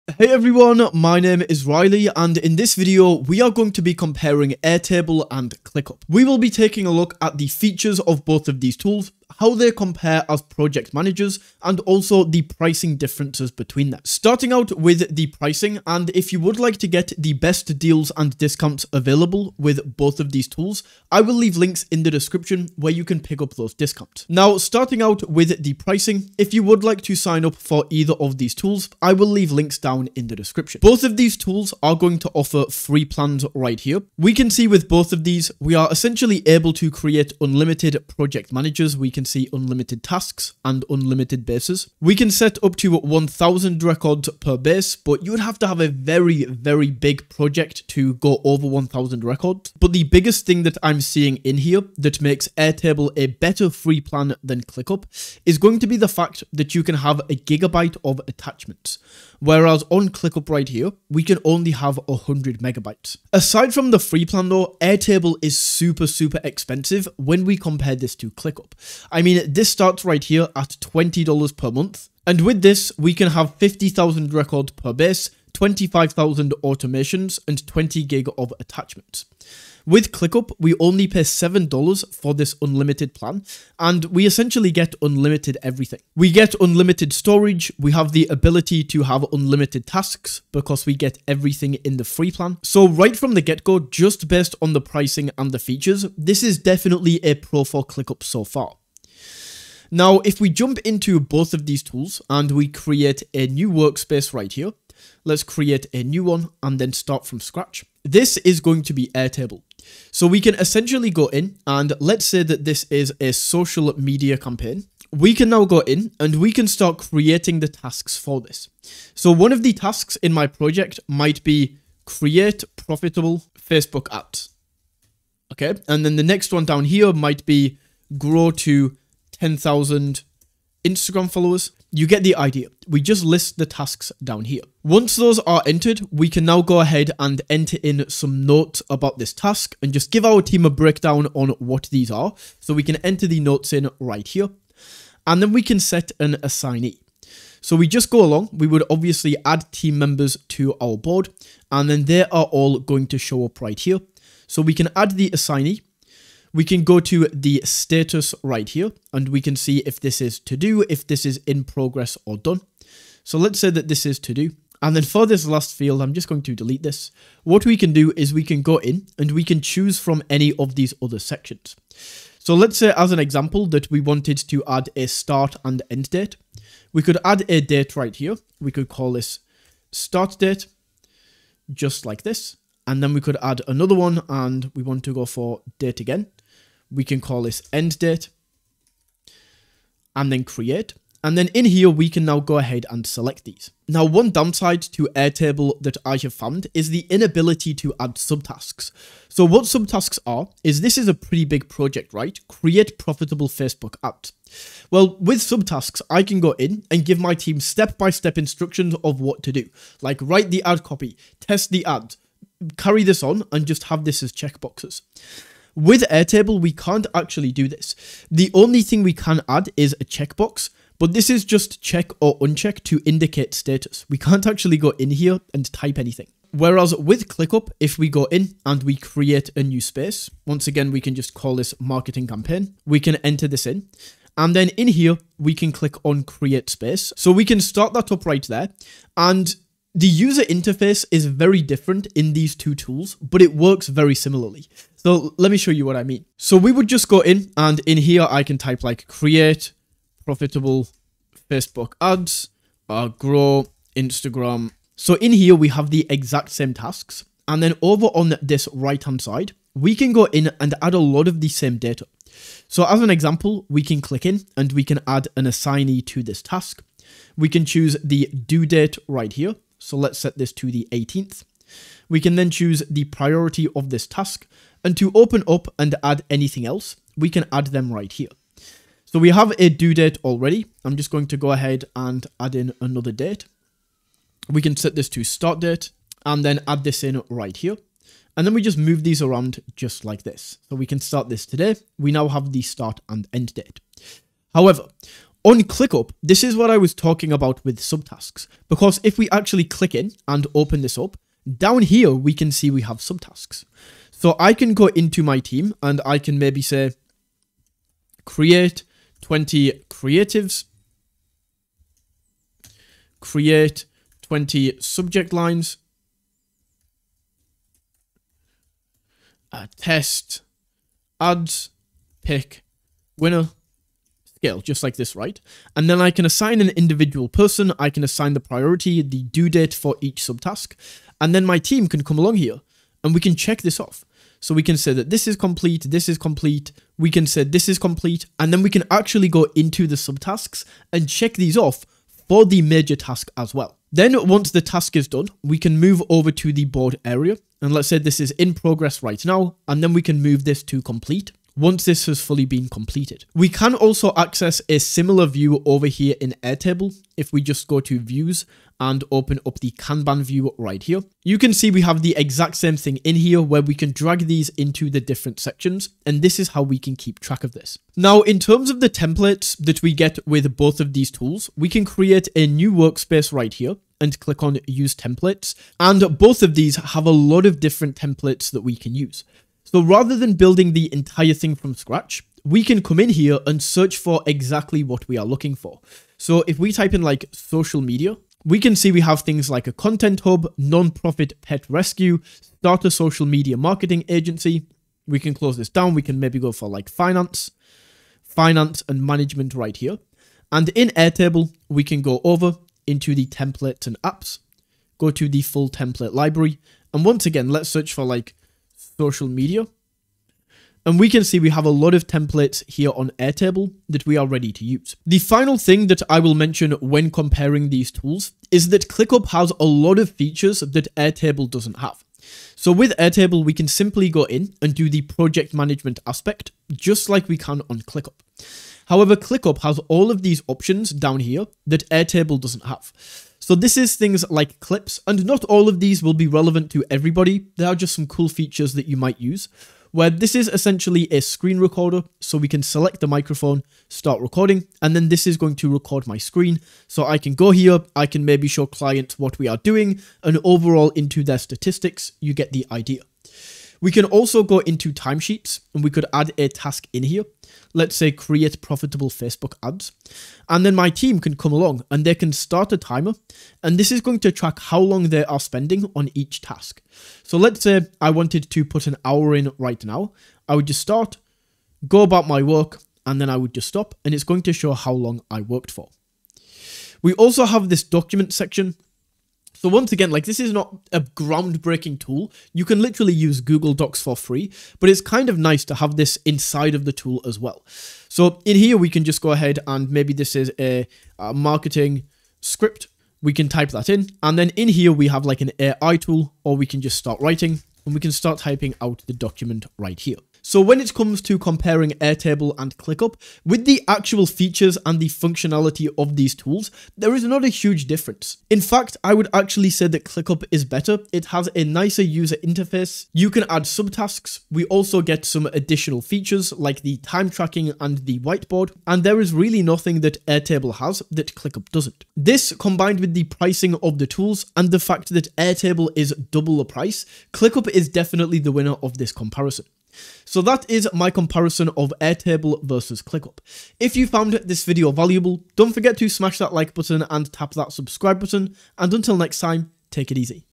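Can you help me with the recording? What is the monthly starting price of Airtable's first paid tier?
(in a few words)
$20.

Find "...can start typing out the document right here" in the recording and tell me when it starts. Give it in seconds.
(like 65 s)
498 s.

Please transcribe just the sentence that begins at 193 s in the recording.
Now, one downside to Airtable that I have found is the inability to add subtasks.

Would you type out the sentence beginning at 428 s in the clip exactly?
However, ClickUp has all of these options down here that Airtable doesn't have.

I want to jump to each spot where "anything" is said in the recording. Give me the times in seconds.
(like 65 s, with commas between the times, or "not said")
225 s, 276 s.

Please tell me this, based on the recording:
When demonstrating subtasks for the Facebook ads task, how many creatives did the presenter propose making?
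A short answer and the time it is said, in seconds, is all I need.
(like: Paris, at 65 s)
20, at 309 s.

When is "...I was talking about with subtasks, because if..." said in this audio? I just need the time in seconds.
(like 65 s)
296 s.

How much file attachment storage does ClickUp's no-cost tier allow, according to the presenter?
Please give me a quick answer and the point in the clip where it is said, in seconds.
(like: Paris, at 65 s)
100 megabytes, at 62 s.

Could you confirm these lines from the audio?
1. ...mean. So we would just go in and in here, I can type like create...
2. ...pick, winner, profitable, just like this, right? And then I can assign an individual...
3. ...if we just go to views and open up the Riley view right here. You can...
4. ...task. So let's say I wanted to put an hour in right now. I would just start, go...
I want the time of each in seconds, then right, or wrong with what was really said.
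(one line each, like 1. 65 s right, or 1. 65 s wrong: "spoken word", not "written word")
1. 246 s right
2. 322 s wrong: "scale", not "profitable"
3. 357 s wrong: "Kanban", not "Riley"
4. 466 s right.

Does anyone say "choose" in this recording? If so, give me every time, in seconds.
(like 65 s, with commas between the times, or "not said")
169 s, 267 s, 272 s.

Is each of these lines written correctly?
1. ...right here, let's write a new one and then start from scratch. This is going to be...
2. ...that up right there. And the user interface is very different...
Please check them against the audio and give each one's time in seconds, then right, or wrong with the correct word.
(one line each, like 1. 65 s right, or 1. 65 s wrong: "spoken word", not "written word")
1. 104 s wrong: "create", not "write"
2. 237 s right.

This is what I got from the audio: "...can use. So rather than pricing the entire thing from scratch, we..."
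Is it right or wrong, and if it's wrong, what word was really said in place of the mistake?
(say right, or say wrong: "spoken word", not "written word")
wrong: "building", not "pricing".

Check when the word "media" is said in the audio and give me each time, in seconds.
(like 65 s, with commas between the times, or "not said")
113 s, 387 s, 393 s, 409 s.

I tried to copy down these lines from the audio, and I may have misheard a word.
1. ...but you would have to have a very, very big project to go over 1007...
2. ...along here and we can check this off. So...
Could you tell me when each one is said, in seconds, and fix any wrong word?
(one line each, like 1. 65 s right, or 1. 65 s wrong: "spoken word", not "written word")
1. 44 s wrong: "1000", not "1007"
2. 332 s right.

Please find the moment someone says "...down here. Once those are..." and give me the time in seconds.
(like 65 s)
134 s.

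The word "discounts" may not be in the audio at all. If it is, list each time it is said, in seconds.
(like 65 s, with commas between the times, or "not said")
18 s, 23 s.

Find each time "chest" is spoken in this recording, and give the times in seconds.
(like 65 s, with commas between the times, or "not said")
not said.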